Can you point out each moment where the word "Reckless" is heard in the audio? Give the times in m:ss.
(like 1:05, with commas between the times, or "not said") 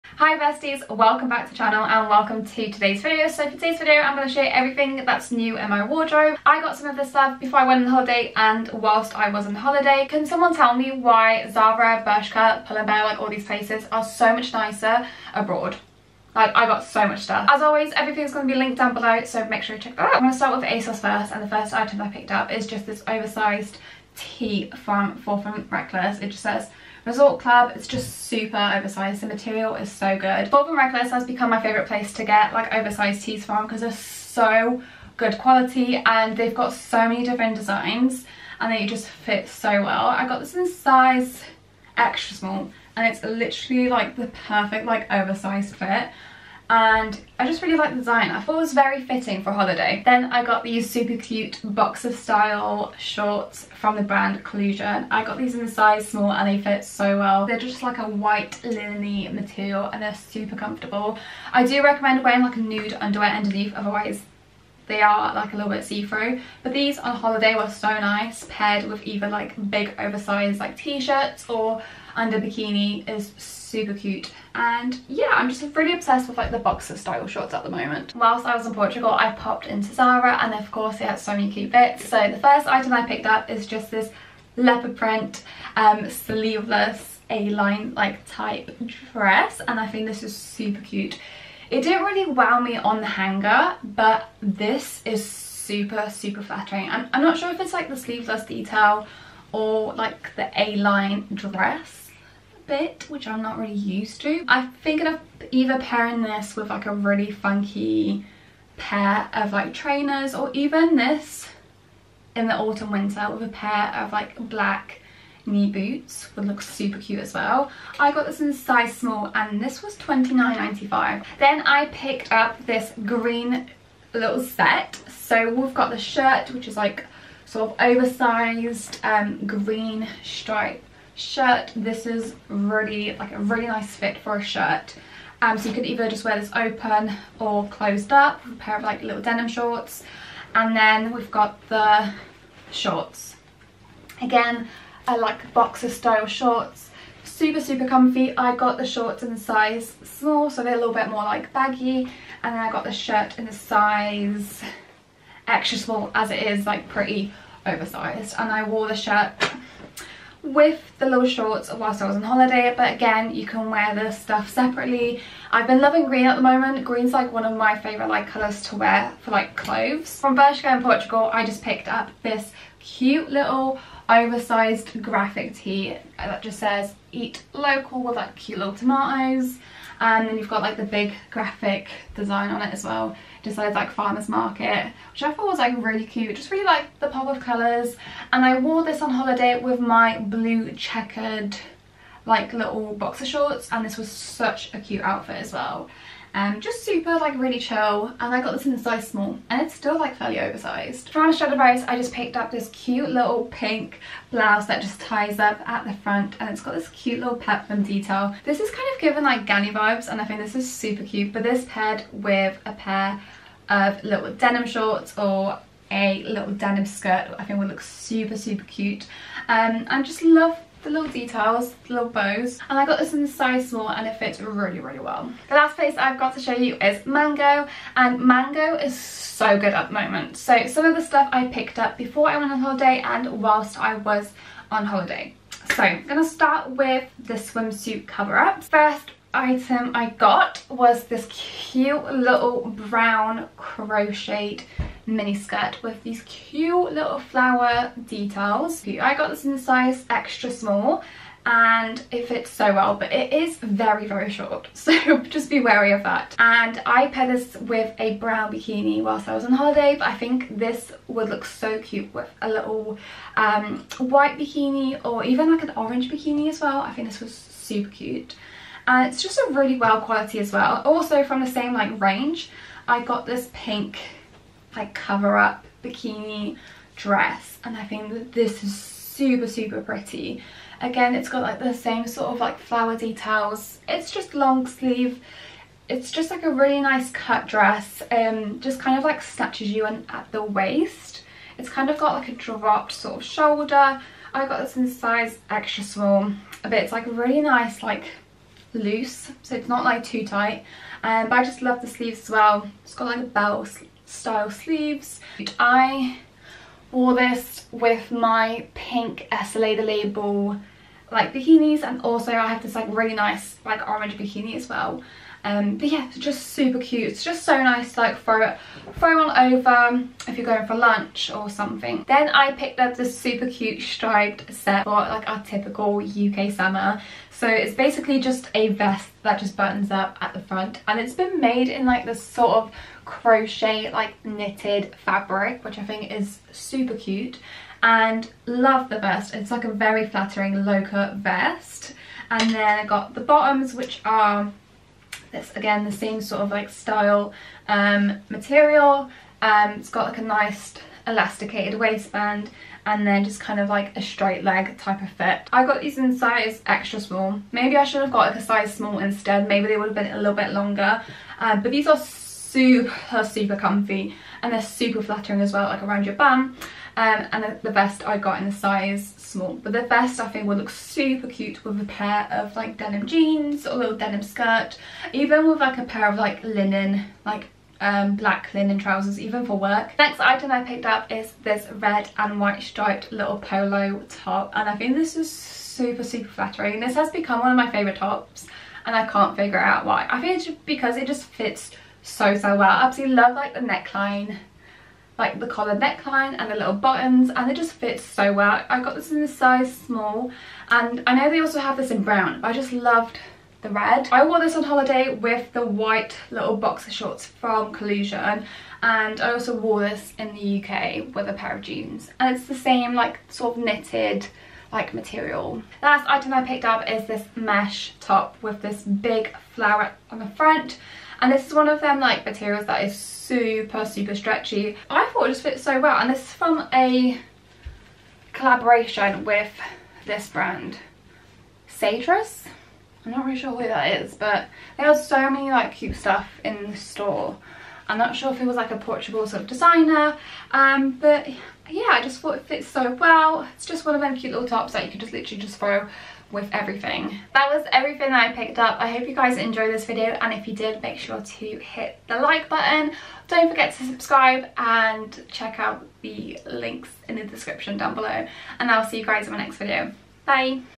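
0:25, 0:30.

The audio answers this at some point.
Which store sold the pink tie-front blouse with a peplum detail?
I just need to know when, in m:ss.
3:21.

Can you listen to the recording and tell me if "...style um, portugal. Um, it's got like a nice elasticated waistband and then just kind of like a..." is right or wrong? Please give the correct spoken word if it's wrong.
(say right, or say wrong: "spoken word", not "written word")
wrong: "material", not "portugal".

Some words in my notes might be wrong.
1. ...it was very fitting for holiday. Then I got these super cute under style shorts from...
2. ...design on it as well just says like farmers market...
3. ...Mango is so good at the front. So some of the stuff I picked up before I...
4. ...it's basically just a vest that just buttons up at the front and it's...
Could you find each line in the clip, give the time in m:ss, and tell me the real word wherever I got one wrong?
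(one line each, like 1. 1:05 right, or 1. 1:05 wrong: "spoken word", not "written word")
1. 0:48 wrong: "boxer", not "under"
2. 3:02 right
3. 3:48 wrong: "moment", not "front"
4. 5:27 right.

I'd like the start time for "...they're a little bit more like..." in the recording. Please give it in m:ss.
2:30.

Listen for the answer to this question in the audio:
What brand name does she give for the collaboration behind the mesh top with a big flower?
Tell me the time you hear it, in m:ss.
7:11.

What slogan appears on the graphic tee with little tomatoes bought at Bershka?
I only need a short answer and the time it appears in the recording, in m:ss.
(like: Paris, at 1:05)
eat local, at 2:57.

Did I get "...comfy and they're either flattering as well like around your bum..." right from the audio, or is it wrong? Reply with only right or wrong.
wrong.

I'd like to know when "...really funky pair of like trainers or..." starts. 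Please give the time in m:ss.
1:46.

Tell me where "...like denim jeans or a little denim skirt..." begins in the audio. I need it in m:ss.
6:12.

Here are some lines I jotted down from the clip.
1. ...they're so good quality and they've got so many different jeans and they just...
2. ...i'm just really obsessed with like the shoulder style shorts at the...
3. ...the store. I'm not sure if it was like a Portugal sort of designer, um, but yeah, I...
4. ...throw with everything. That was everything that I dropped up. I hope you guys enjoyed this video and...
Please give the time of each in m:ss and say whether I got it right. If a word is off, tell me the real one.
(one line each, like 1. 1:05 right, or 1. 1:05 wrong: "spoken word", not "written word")
1. 0:33 wrong: "designs", not "jeans"
2. 1:15 wrong: "boxer", not "shoulder"
3. 7:16 right
4. 7:25 wrong: "picked", not "dropped".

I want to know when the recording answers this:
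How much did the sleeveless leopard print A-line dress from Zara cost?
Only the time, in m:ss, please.
1:59.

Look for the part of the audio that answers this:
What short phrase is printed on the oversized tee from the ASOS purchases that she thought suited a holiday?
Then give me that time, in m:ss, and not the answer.
0:27.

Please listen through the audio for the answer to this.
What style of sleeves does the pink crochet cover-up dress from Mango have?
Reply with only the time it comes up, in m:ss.
5:03.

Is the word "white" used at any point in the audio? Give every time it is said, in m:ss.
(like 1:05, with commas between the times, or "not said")
0:58, 4:23, 6:22, 6:45.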